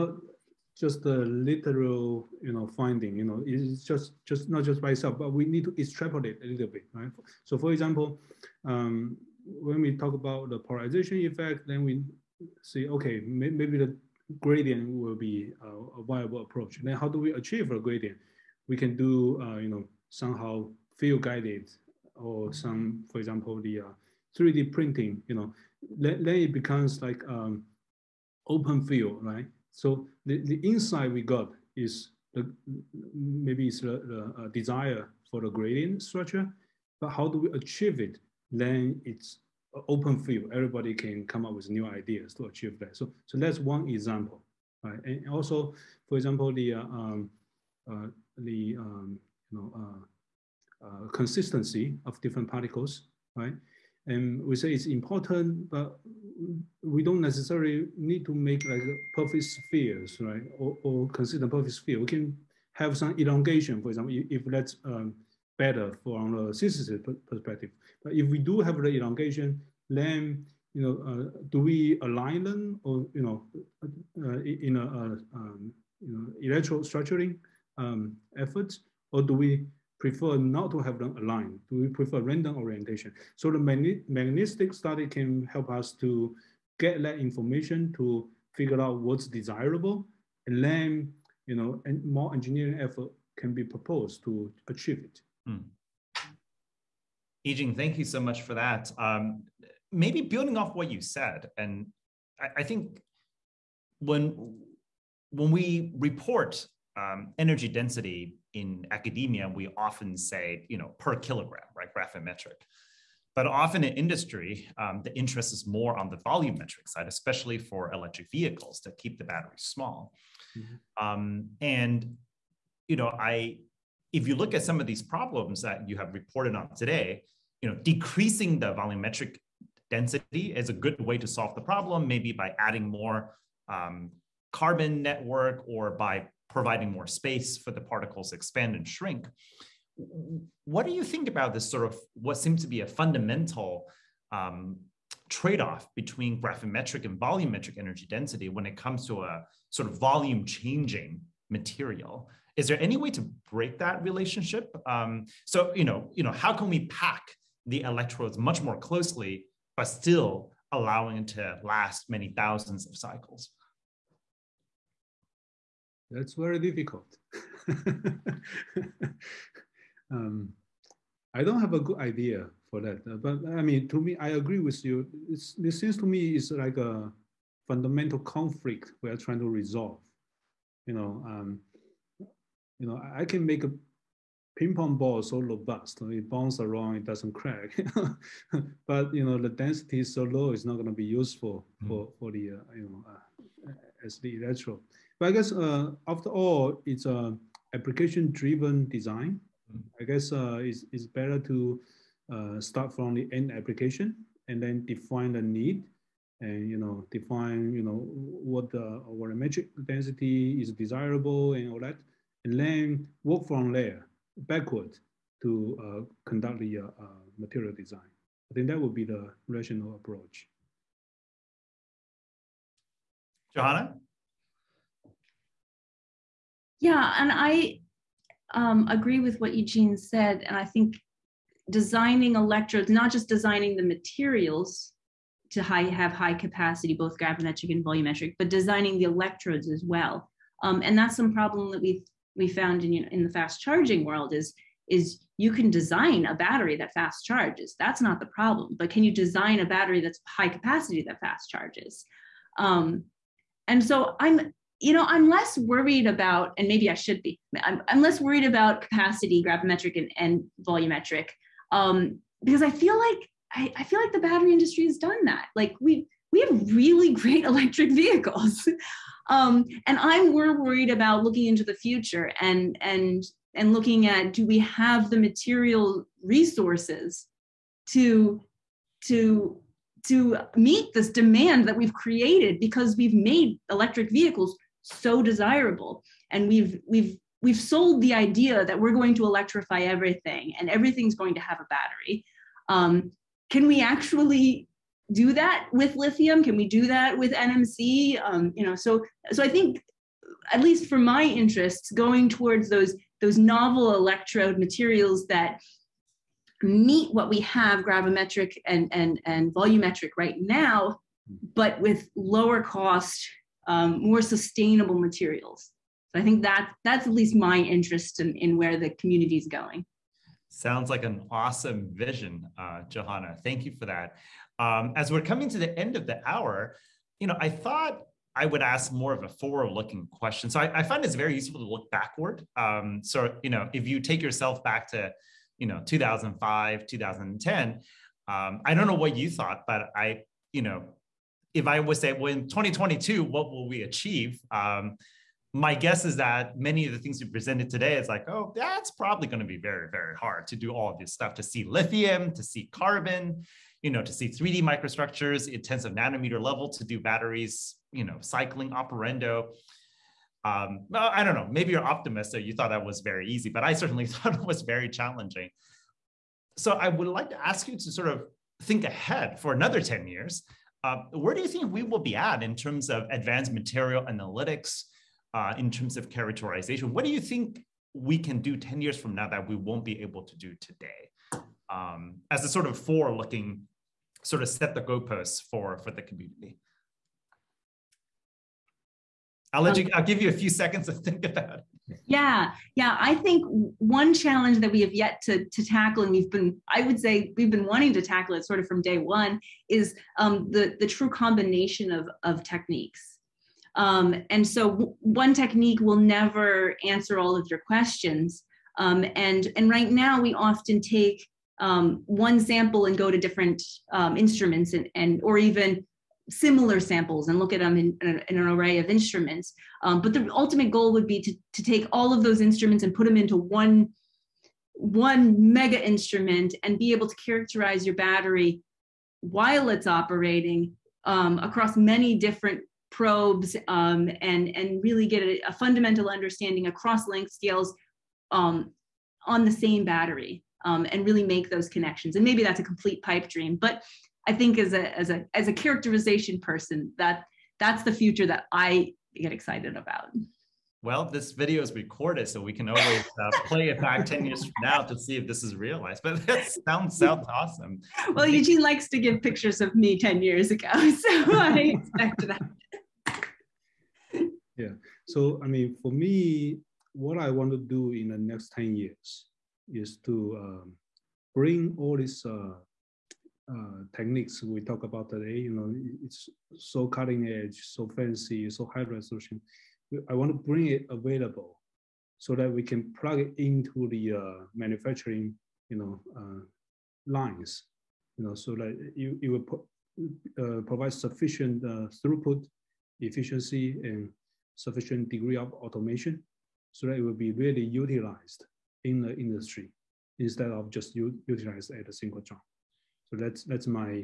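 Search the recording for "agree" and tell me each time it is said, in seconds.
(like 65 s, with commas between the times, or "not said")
174 s, 228 s.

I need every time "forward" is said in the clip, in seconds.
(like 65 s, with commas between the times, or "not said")
329 s, 382 s.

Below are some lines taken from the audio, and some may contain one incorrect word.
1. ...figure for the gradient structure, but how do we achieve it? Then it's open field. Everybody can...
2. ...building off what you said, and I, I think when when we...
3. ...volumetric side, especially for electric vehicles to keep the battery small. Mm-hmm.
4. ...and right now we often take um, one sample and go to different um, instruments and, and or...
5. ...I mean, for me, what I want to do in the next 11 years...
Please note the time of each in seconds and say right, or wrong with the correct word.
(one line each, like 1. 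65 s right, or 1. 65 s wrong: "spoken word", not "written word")
1. 34 s wrong: "desire", not "figure"
2. 100 s right
3. 116 s right
4. 409 s right
5. 465 s wrong: "10", not "11".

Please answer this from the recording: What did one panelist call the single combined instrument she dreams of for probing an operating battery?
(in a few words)
mega instrument.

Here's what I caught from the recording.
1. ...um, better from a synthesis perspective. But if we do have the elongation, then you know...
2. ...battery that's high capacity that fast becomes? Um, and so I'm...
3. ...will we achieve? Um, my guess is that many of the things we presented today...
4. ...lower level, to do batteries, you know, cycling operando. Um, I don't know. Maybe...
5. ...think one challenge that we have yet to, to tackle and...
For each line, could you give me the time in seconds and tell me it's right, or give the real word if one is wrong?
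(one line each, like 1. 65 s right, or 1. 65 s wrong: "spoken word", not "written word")
1. 64 s right
2. 249 s wrong: "charges", not "becomes"
3. 343 s right
4. 355 s wrong: "nanometer", not "lower"
5. 393 s right.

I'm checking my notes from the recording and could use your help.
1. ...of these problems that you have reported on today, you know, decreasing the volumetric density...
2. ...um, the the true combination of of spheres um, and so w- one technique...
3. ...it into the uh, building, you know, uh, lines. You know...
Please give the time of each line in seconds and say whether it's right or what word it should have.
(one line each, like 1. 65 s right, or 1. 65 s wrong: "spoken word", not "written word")
1. 124 s right
2. 400 s wrong: "techniques", not "spheres"
3. 483 s wrong: "manufacturing", not "building".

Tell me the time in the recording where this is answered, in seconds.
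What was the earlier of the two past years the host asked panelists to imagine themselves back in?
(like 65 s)
335 s.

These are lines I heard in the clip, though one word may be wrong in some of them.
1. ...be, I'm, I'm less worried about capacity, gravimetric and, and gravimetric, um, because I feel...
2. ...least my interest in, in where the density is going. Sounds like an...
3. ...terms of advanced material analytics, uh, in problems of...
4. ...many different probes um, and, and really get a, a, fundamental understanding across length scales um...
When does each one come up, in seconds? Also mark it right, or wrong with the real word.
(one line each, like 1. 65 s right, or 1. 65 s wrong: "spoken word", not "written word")
1. 257 s wrong: "volumetric", not "gravimetric"
2. 317 s wrong: "community", not "density"
3. 372 s wrong: "terms", not "problems"
4. 431 s right.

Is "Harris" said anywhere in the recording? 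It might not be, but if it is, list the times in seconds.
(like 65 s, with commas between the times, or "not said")
not said.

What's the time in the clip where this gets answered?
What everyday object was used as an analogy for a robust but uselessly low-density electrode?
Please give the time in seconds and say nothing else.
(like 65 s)
184 s.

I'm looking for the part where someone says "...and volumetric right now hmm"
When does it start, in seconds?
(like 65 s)
309 s.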